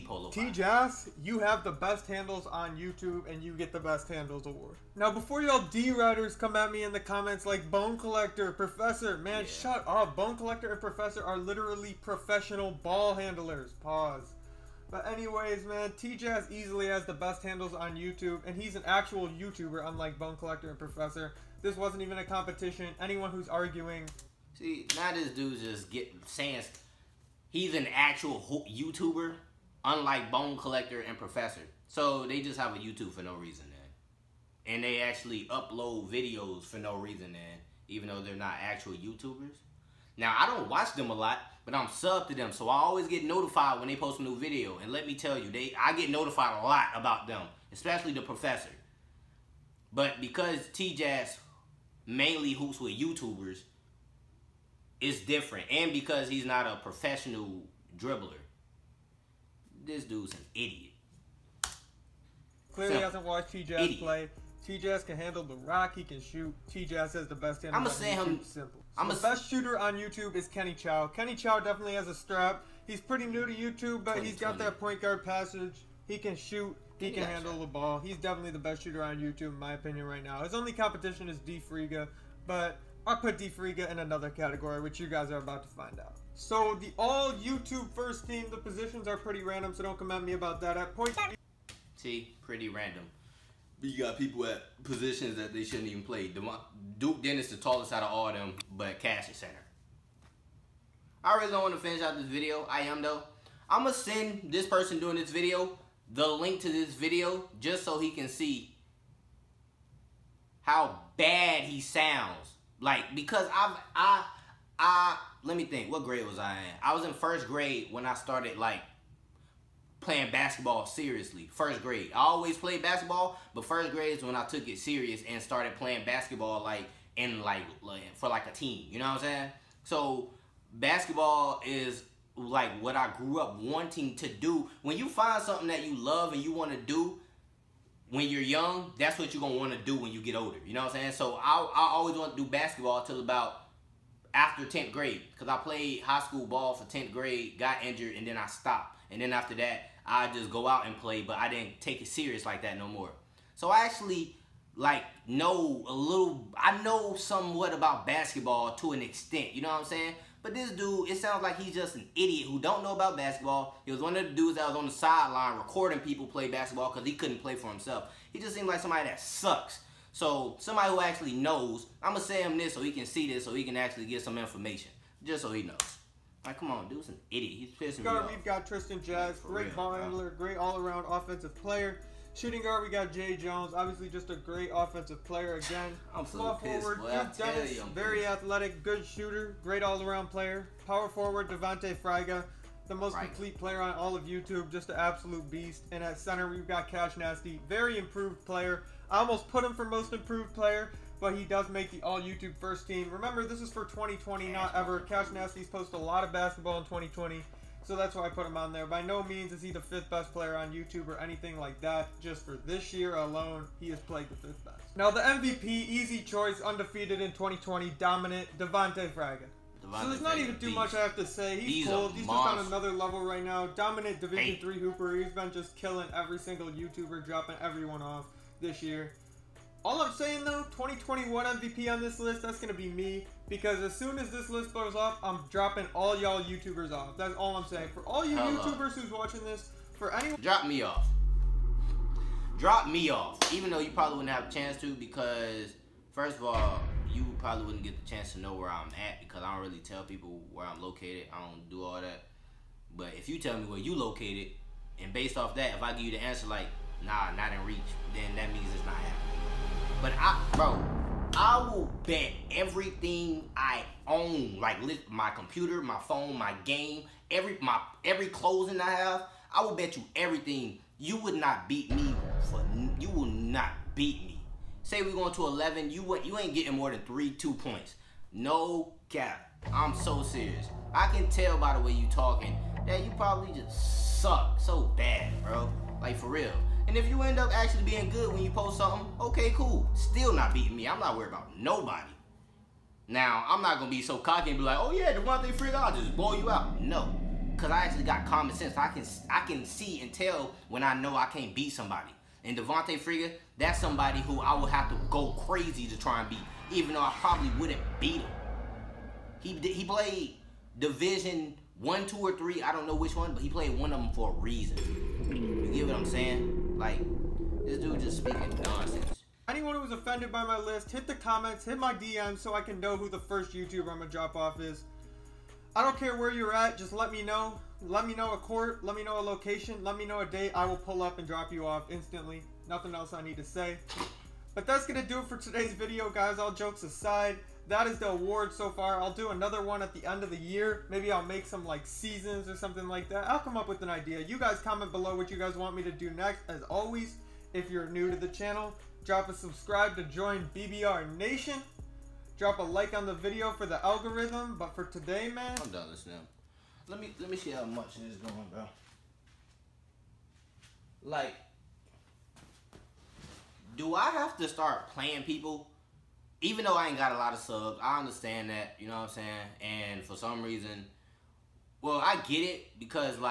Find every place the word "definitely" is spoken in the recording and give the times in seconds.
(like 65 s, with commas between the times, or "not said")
71 s, 78 s.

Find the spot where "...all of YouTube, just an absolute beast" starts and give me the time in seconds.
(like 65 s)
193 s.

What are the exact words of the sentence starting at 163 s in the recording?
He was one of the dudes that was on the sideline recording people play basketball because he couldn't play for himself.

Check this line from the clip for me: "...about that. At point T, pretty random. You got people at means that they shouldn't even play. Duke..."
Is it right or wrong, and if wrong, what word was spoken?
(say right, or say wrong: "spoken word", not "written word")
wrong: "positions", not "means".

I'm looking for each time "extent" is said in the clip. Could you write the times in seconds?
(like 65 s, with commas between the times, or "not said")
159 s.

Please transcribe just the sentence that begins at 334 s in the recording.
But that's gonna do it for today's video, guys.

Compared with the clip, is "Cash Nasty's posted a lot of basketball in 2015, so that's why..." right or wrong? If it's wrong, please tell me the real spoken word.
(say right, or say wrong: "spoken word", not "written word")
wrong: "2020", not "2015".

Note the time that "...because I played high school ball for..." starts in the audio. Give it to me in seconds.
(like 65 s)
145 s.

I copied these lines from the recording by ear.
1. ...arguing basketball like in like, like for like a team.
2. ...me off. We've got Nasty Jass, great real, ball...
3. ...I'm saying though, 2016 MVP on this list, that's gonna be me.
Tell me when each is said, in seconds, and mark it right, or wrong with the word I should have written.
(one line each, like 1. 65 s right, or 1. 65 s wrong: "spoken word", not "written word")
1. 125 s wrong: "playing", not "arguing"
2. 178 s wrong: "Tristan", not "Nasty"
3. 230 s wrong: "2021", not "2016".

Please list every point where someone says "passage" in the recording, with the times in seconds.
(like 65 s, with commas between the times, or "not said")
75 s.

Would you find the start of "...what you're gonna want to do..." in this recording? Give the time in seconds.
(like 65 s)
139 s.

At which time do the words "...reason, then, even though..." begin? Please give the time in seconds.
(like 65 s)
36 s.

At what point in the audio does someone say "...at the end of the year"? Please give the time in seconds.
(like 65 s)
339 s.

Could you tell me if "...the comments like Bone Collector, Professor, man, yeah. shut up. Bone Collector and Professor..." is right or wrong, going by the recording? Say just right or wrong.
right.